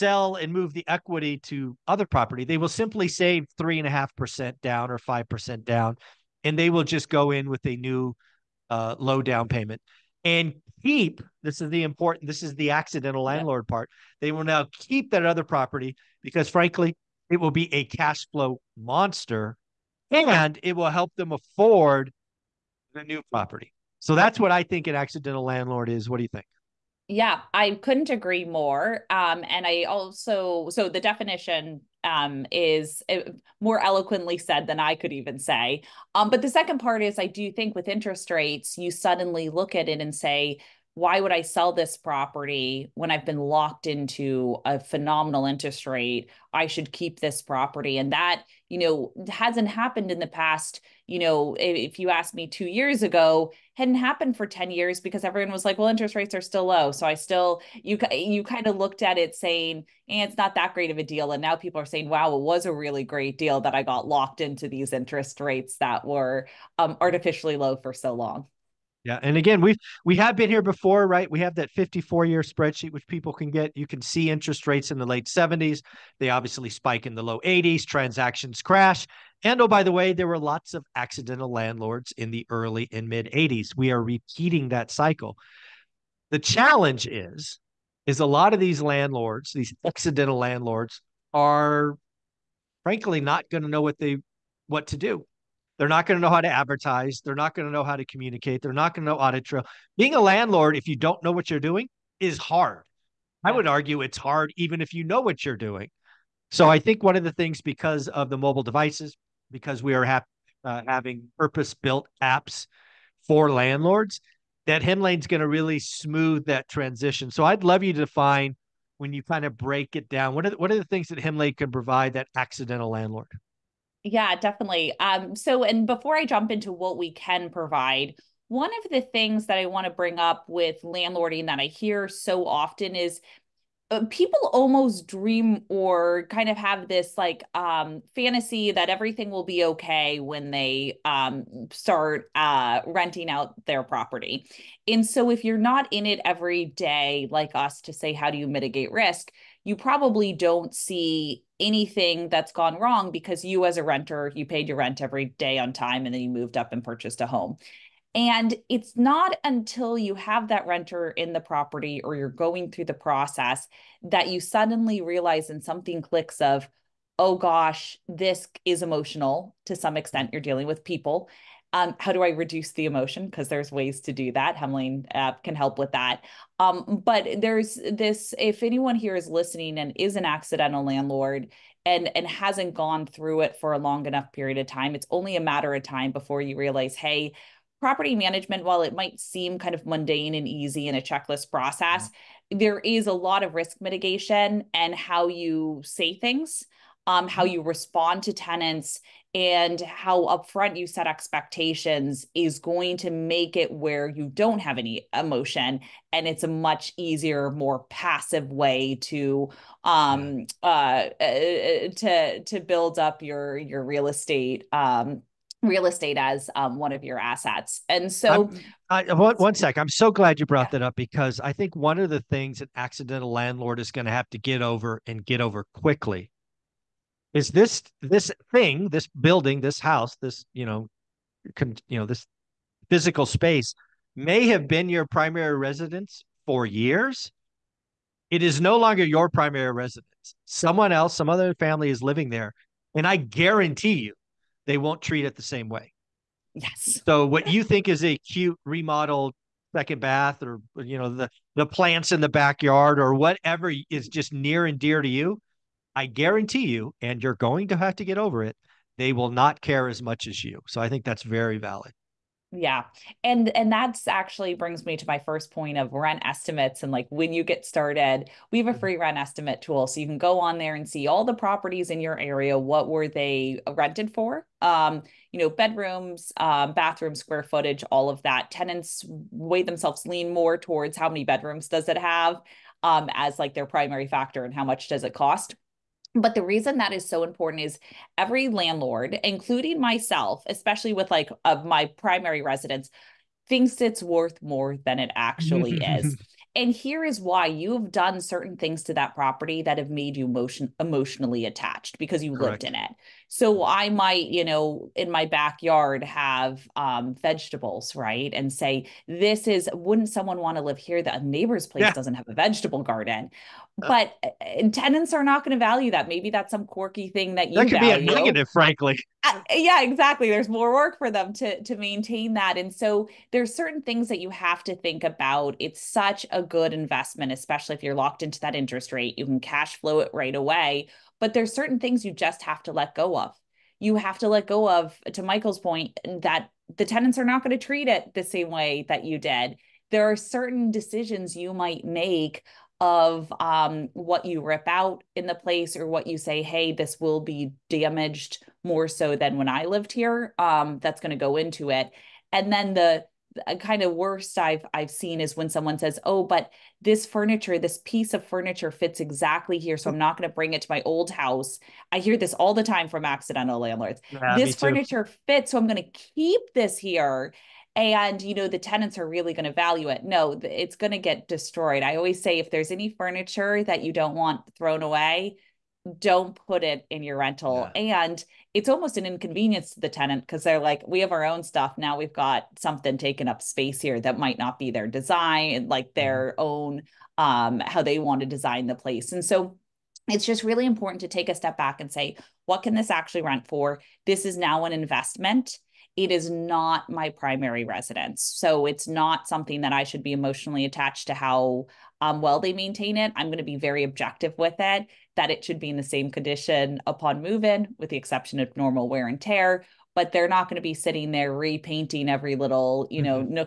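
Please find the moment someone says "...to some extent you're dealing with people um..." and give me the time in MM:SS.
02:49.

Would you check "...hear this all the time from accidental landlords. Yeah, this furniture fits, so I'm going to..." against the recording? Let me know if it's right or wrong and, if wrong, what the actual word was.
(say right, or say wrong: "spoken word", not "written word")
right.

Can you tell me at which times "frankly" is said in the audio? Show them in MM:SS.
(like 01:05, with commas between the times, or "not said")
00:16, 01:32, 05:18.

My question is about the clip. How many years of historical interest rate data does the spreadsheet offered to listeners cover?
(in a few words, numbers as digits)
54.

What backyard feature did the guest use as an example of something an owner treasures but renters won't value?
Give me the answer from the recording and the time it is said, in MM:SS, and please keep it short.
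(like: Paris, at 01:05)
Vegetable garden, at 05:12.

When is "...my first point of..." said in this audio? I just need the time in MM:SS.
04:25.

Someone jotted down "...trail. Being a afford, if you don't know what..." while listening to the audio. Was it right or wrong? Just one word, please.
wrong.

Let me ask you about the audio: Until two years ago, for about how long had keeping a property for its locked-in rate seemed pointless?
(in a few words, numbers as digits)
10 years.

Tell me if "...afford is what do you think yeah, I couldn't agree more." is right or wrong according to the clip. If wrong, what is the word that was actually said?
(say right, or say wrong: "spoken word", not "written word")
wrong: "landlord", not "afford".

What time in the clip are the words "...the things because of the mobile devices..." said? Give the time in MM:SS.
01:47.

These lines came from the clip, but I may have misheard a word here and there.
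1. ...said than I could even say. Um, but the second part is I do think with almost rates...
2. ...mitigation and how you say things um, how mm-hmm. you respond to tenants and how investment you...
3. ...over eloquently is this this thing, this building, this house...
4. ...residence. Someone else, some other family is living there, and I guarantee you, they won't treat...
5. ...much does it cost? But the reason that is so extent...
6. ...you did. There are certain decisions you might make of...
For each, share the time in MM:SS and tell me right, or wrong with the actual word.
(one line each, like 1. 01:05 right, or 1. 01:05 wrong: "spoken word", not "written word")
1. 00:34 wrong: "interest", not "almost"
2. 03:13 wrong: "upfront", not "investment"
3. 03:45 wrong: "quickly", not "eloquently"
4. 03:59 right
5. 04:44 wrong: "important", not "extent"
6. 05:39 right.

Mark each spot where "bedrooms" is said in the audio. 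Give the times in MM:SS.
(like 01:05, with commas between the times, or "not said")
04:35, 04:41.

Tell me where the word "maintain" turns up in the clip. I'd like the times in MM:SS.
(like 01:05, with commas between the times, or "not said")
05:21, 06:42.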